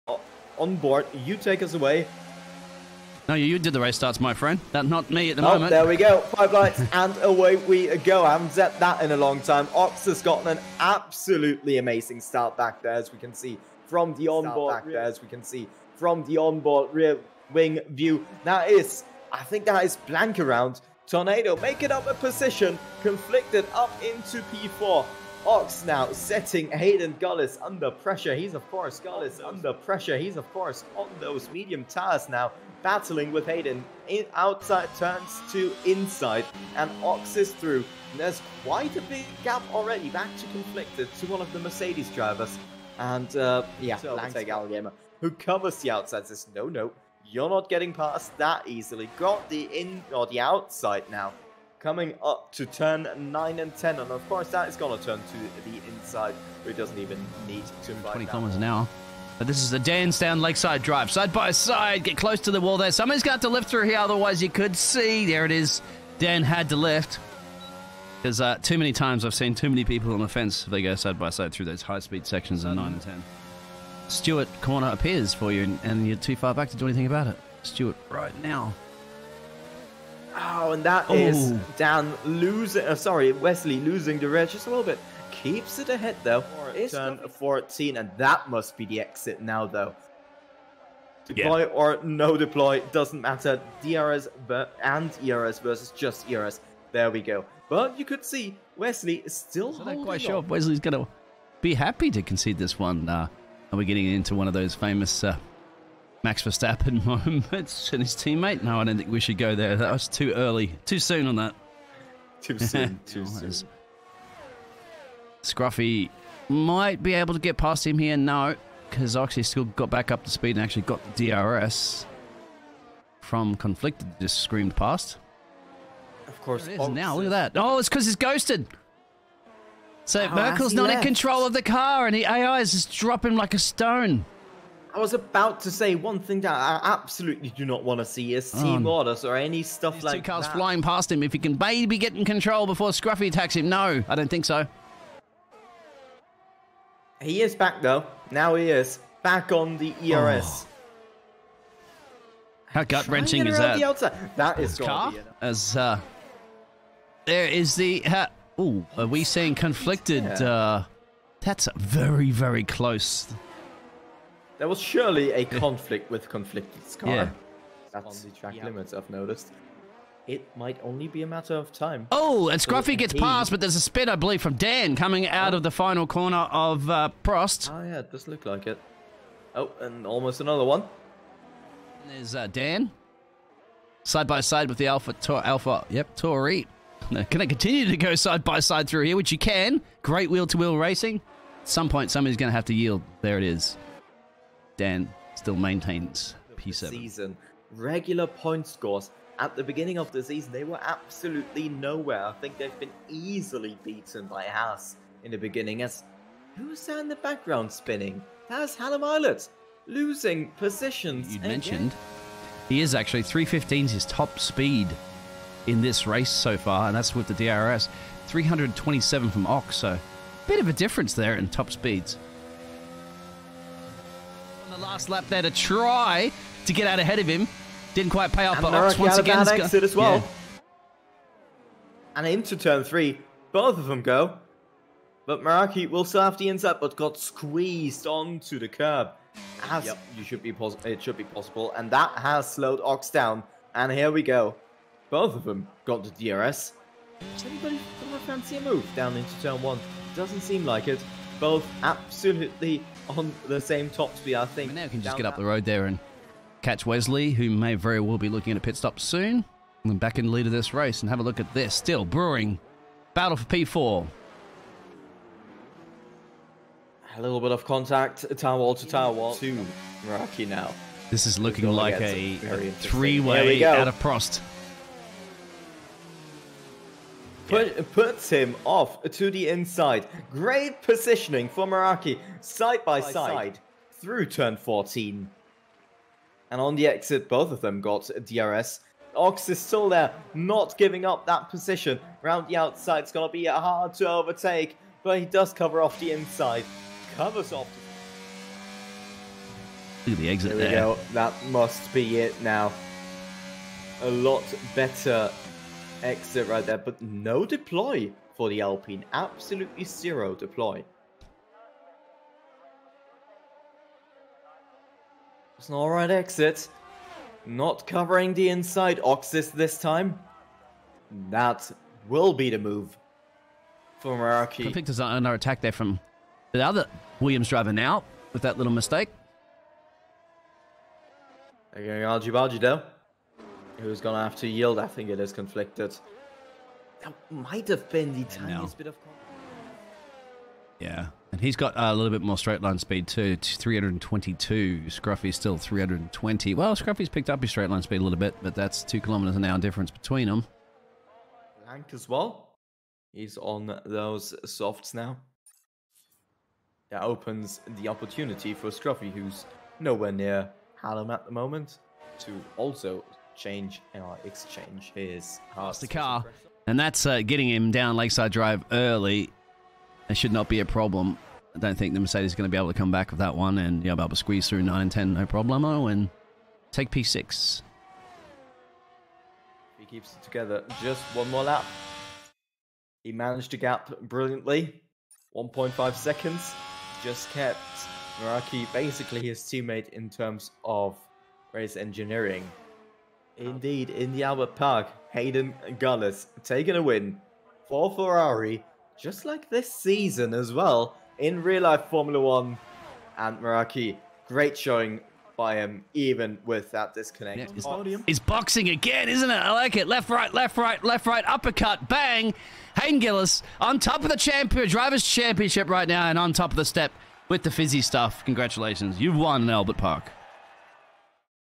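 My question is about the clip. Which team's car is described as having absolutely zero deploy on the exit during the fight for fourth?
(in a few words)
Alpine.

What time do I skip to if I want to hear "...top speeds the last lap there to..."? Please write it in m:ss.
3:41.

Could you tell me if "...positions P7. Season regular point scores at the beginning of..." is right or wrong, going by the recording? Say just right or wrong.
wrong.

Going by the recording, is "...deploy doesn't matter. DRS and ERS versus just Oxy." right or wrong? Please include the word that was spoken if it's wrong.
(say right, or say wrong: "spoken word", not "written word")
wrong: "ERS", not "Oxy".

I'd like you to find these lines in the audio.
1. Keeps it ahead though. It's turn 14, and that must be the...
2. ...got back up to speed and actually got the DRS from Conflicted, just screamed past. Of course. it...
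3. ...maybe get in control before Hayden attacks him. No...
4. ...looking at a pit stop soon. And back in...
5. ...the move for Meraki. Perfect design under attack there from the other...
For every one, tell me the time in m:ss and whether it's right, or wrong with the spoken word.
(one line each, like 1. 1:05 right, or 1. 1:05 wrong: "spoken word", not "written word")
1. 1:25 right
2. 1:59 right
3. 2:21 wrong: "Scruffy", not "Hayden"
4. 4:18 right
5. 5:22 right.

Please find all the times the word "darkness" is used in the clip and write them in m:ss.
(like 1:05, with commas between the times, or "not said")
not said.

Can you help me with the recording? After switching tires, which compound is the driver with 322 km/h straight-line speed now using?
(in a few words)
Softs.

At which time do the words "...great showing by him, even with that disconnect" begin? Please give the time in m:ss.
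6:44.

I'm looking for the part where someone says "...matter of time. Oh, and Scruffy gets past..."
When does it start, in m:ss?
2:51.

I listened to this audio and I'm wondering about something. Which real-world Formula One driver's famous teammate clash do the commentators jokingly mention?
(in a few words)
Max Verstappen.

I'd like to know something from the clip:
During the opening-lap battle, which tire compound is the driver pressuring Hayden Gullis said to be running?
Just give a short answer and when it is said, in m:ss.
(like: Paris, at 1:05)
Medium, at 0:31.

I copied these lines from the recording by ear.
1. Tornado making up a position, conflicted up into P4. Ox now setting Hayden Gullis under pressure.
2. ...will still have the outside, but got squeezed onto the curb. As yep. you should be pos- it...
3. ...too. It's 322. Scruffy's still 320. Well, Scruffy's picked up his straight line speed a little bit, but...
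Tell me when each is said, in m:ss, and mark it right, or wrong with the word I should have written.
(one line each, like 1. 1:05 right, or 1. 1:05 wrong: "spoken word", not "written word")
1. 0:21 right
2. 3:55 wrong: "inside", not "outside"
3. 5:43 right.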